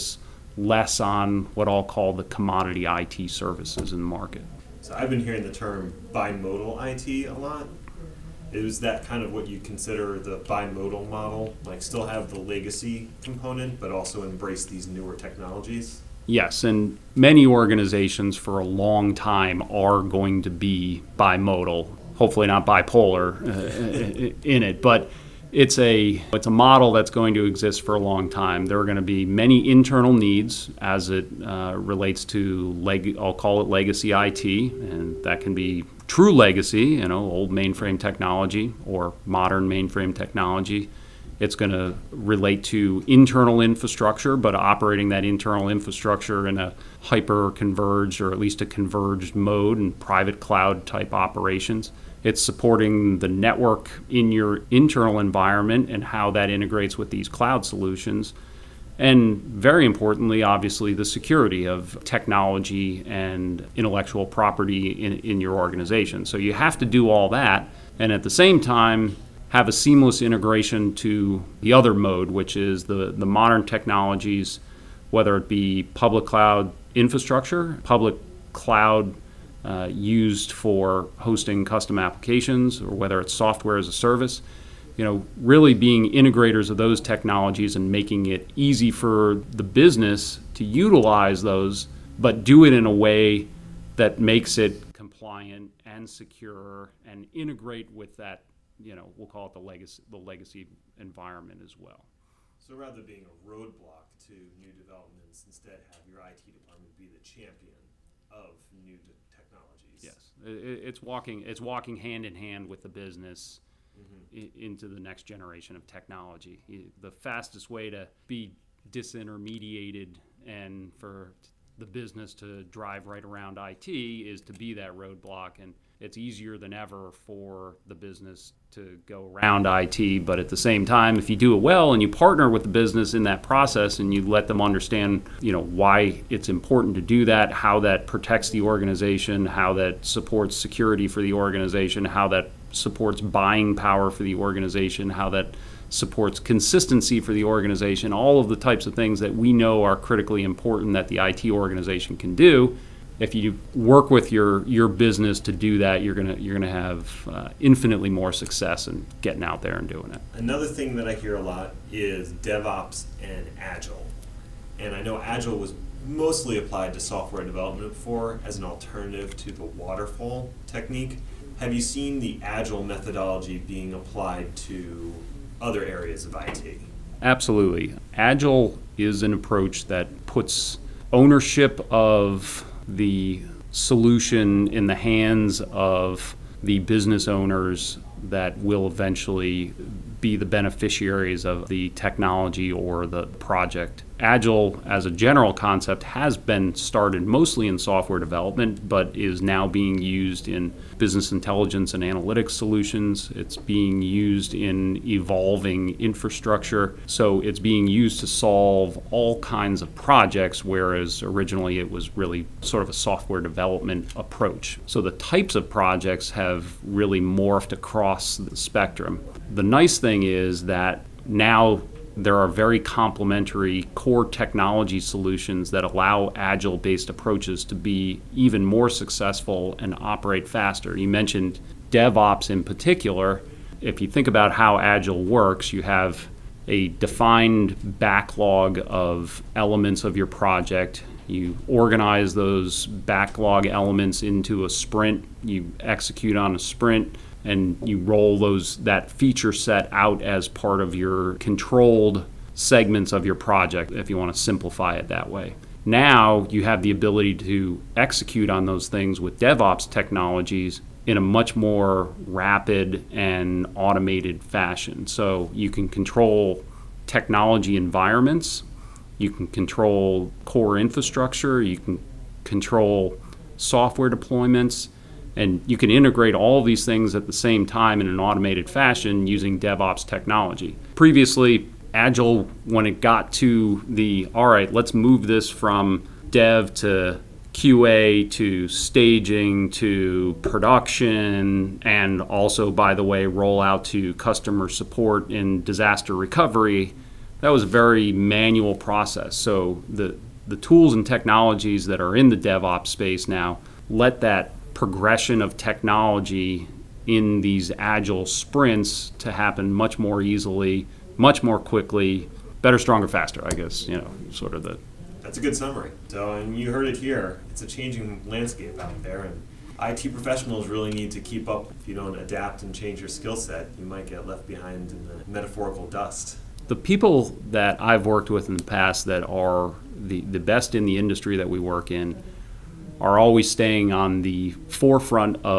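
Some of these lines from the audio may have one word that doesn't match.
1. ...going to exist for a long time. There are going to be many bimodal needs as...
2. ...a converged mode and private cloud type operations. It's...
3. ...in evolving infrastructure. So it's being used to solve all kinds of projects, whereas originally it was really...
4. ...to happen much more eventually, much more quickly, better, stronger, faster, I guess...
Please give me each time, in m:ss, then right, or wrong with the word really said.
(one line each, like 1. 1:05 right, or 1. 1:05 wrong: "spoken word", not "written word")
1. 0:27 wrong: "internal", not "bimodal"
2. 0:48 right
3. 3:24 right
4. 5:09 wrong: "easily", not "eventually".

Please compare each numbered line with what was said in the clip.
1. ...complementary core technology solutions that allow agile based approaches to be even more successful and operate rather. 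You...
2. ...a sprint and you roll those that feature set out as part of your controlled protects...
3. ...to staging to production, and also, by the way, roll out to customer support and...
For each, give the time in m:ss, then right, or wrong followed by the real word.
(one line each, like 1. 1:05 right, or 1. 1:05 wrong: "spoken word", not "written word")
1. 3:42 wrong: "faster", not "rather"
2. 4:06 wrong: "segments", not "protects"
3. 4:48 right.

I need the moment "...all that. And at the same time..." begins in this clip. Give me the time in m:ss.
1:07.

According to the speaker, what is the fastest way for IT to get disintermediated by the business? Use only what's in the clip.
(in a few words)
being a roadblock.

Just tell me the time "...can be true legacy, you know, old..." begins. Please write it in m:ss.
0:35.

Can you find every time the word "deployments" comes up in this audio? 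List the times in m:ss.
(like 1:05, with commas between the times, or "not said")
4:34.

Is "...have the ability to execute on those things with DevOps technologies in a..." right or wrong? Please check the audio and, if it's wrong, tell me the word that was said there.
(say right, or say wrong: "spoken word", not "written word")
right.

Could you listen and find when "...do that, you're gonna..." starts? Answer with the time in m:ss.
2:35.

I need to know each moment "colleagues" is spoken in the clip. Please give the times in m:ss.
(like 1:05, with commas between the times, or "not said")
not said.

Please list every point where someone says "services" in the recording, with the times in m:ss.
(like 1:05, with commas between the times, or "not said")
0:03, 1:23.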